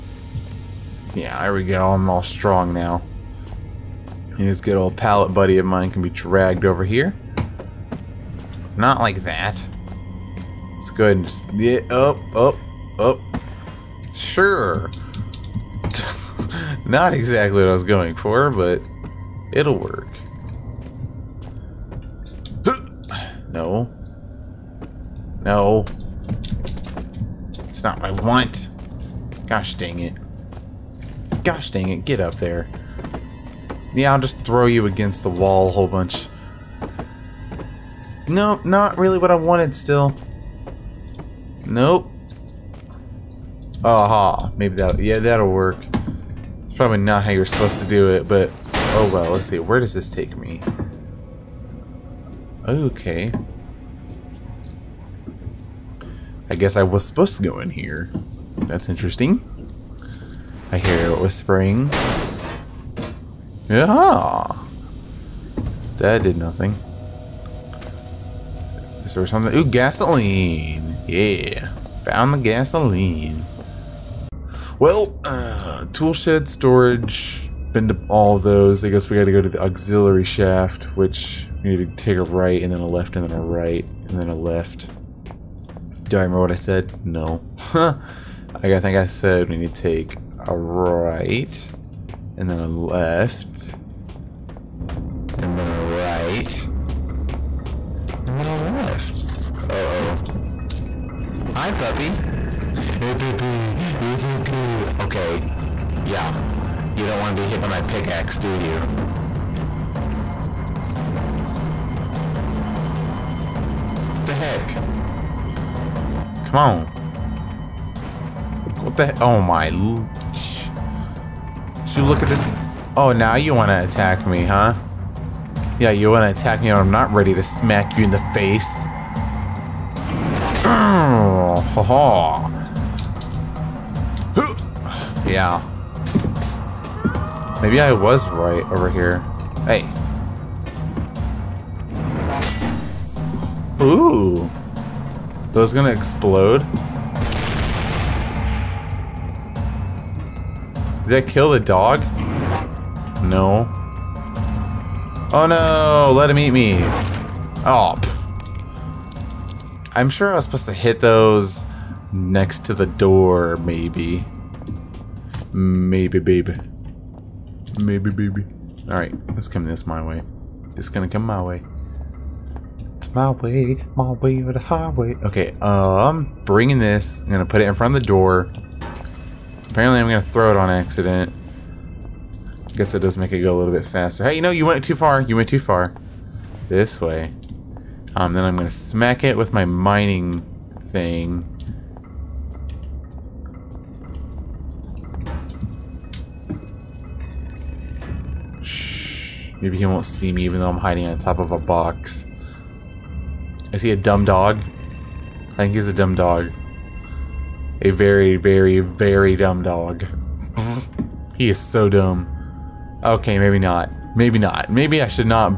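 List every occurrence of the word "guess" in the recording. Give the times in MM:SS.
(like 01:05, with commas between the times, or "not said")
00:56, 01:18, 03:02.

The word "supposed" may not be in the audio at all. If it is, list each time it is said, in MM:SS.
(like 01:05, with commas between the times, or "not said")
00:47, 00:57, 02:40.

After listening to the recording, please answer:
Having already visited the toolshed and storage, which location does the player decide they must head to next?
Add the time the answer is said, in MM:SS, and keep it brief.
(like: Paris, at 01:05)
the auxiliary shaft, at 01:19.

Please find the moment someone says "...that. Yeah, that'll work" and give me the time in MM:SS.
00:44.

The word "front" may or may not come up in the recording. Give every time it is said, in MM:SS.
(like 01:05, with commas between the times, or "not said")
02:57.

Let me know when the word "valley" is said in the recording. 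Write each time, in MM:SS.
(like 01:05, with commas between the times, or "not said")
not said.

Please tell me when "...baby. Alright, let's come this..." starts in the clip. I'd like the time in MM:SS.
02:48.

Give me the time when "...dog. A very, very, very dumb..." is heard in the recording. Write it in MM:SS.
03:26.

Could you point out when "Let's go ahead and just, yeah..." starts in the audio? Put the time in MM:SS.
00:10.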